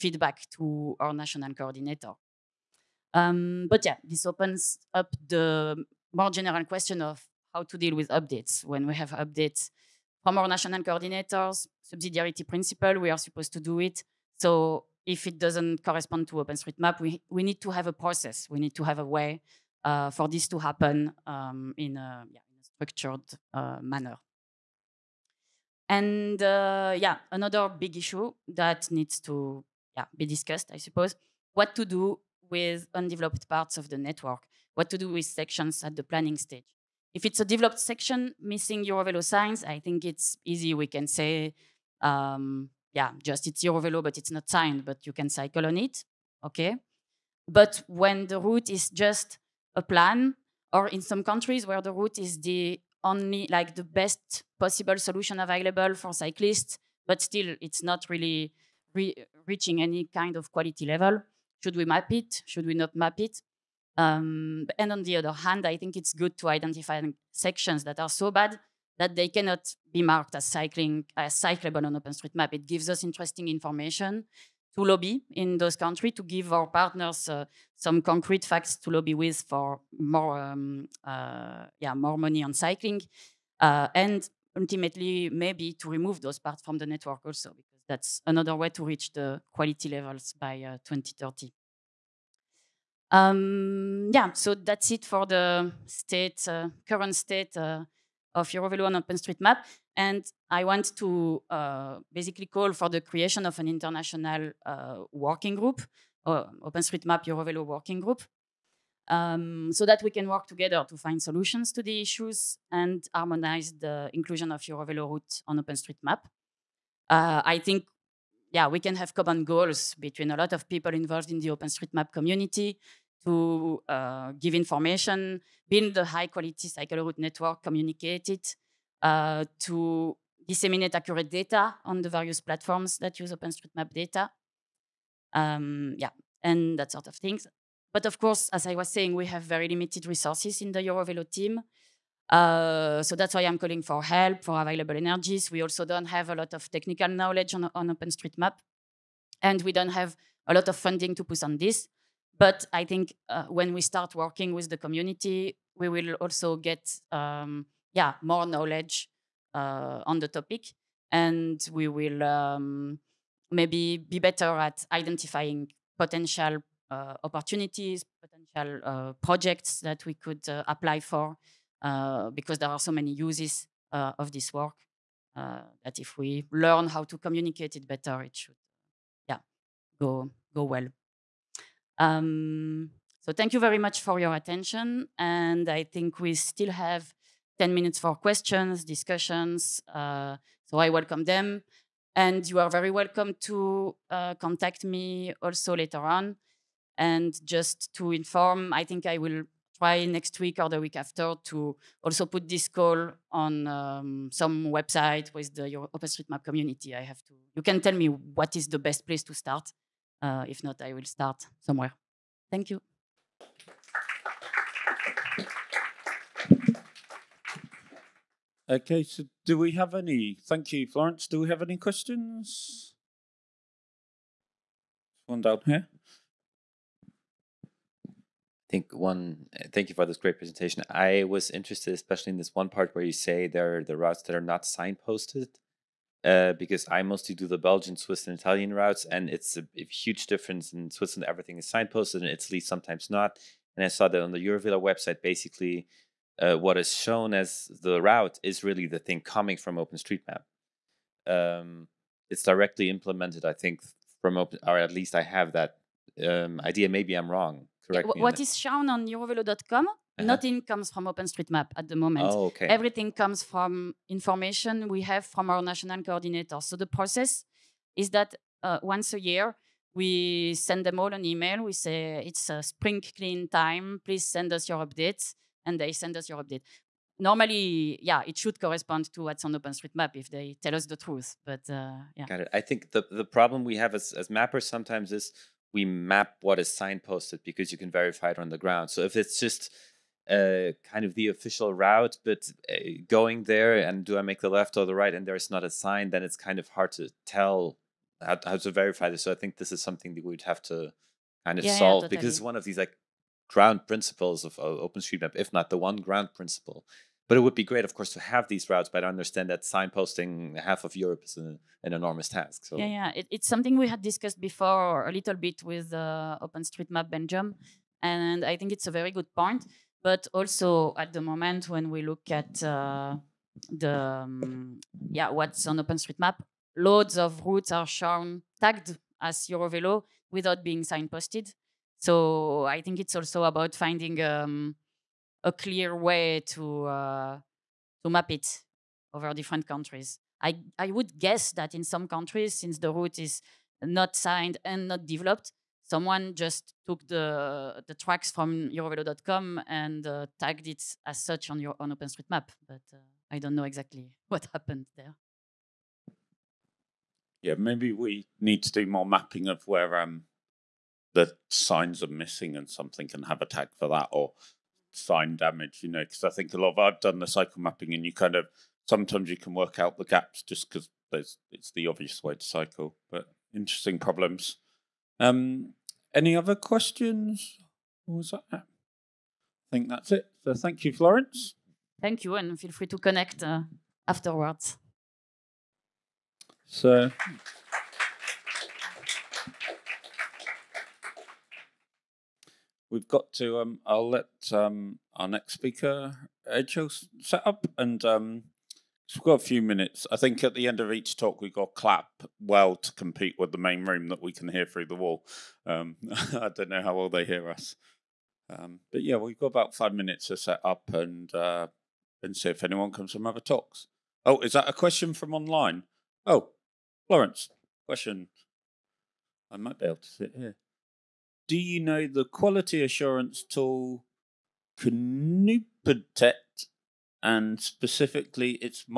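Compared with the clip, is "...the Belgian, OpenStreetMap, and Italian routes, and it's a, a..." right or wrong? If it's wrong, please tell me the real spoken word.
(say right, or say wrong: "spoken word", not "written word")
wrong: "Swiss", not "OpenStreetMap".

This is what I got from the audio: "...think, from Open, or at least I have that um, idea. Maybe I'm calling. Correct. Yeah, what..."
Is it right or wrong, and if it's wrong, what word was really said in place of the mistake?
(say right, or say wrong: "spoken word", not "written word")
wrong: "wrong", not "calling".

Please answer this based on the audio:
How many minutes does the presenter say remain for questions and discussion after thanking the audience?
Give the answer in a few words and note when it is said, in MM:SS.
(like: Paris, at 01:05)
10, at 03:07.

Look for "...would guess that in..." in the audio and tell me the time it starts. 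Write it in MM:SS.
05:40.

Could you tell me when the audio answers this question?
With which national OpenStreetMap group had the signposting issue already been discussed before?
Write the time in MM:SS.
05:16.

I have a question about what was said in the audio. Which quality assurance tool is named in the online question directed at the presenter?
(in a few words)
Knooppuntnet.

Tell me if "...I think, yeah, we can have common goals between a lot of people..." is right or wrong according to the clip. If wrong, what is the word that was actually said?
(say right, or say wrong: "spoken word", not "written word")
right.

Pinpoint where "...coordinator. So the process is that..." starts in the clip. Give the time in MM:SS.
04:26.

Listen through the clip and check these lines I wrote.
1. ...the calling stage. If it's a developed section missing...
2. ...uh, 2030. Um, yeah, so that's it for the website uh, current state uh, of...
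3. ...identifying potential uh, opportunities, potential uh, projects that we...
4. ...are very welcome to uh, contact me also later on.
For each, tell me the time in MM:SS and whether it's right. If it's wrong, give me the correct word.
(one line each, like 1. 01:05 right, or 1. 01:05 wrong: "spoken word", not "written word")
1. 00:35 wrong: "planning", not "calling"
2. 01:30 wrong: "state", not "website"
3. 02:44 right
4. 03:12 right.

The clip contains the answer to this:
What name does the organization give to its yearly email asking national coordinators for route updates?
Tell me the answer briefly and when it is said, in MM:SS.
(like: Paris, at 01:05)
Spring clean, at 04:32.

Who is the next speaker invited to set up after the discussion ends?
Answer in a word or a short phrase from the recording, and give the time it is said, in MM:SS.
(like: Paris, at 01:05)
Edge, at 06:36.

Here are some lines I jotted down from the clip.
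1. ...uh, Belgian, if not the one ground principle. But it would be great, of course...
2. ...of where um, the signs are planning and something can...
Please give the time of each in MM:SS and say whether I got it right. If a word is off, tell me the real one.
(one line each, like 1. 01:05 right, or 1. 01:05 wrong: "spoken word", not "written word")
1. 05:04 wrong: "OpenStreetMap", not "Belgian"
2. 05:59 wrong: "missing", not "planning".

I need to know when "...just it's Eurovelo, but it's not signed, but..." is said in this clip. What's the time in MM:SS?
00:43.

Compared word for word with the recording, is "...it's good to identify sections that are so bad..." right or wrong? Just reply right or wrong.
right.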